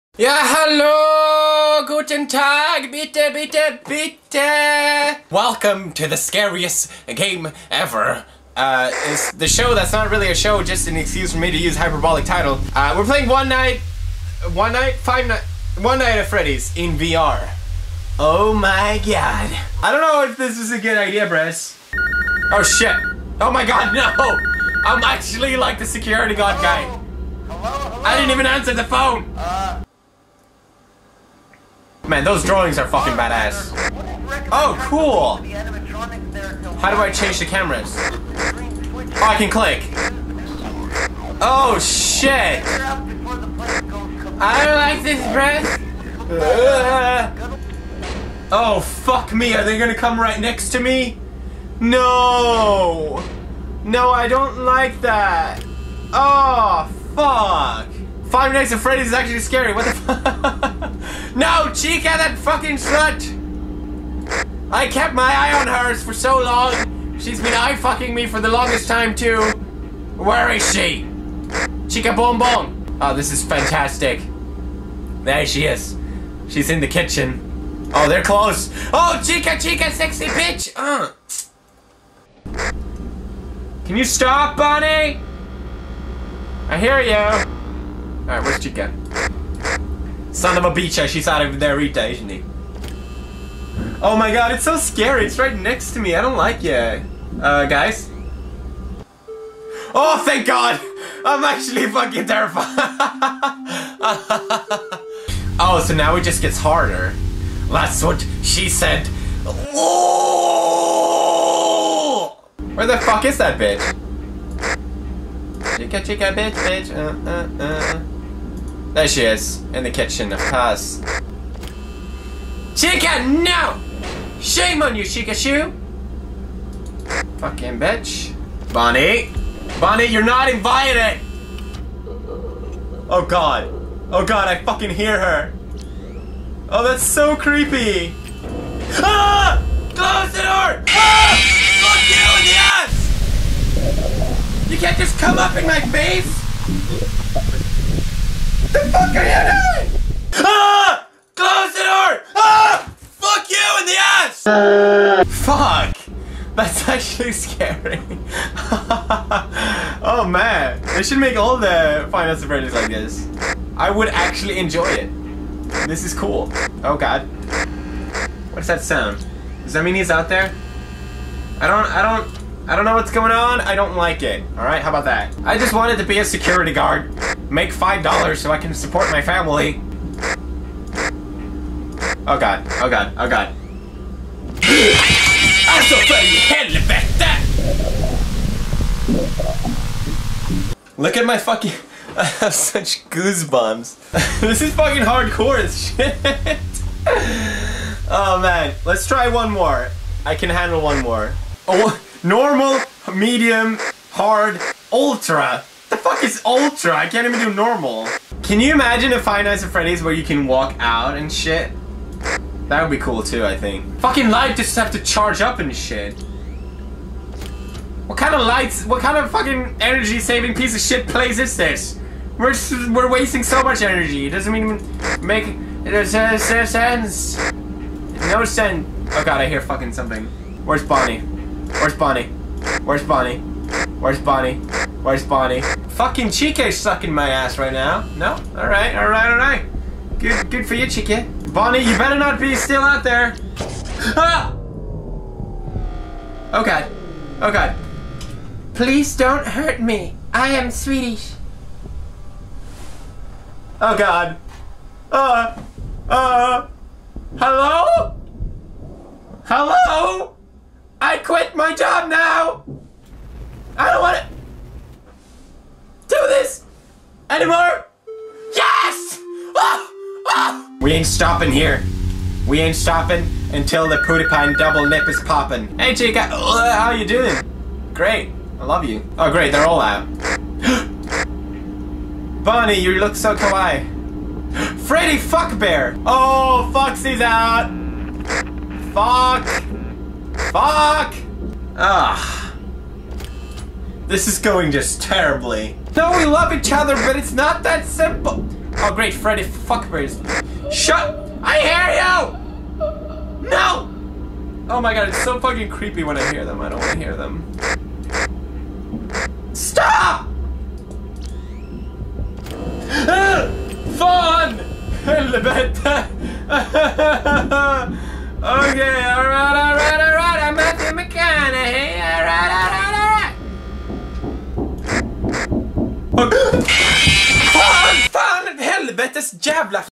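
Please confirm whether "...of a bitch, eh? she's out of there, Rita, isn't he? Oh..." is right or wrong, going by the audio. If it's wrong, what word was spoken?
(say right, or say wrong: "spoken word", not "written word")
right.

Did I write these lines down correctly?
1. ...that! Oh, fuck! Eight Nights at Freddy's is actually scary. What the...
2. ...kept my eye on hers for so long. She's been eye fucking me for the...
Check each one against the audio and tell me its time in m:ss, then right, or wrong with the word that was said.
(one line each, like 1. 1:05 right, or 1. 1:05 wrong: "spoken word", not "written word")
1. 0:54 wrong: "Five", not "Eight"
2. 1:04 right.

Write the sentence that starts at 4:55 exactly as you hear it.
No, we love each other, but it's not that simple.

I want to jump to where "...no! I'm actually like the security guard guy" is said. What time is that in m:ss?
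0:23.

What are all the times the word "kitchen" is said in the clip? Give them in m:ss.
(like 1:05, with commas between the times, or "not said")
1:16, 1:59.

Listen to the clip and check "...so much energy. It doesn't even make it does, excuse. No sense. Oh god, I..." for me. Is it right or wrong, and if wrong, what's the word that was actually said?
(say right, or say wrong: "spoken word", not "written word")
wrong: "sense", not "excuse".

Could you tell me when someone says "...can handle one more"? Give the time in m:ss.
3:20.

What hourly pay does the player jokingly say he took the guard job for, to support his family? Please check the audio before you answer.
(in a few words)
$5.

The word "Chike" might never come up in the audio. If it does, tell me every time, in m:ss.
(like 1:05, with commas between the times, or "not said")
3:56, 4:00.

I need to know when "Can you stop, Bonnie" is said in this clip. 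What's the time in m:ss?
1:23.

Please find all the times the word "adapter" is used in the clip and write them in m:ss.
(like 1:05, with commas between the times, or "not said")
not said.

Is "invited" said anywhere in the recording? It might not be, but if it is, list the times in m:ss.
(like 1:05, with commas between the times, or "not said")
2:10.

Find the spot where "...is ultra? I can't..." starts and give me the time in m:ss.
3:26.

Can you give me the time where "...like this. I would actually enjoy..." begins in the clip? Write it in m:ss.
2:42.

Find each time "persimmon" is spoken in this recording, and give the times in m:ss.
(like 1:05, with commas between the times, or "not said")
not said.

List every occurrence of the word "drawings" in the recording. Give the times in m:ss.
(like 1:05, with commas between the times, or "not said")
0:32.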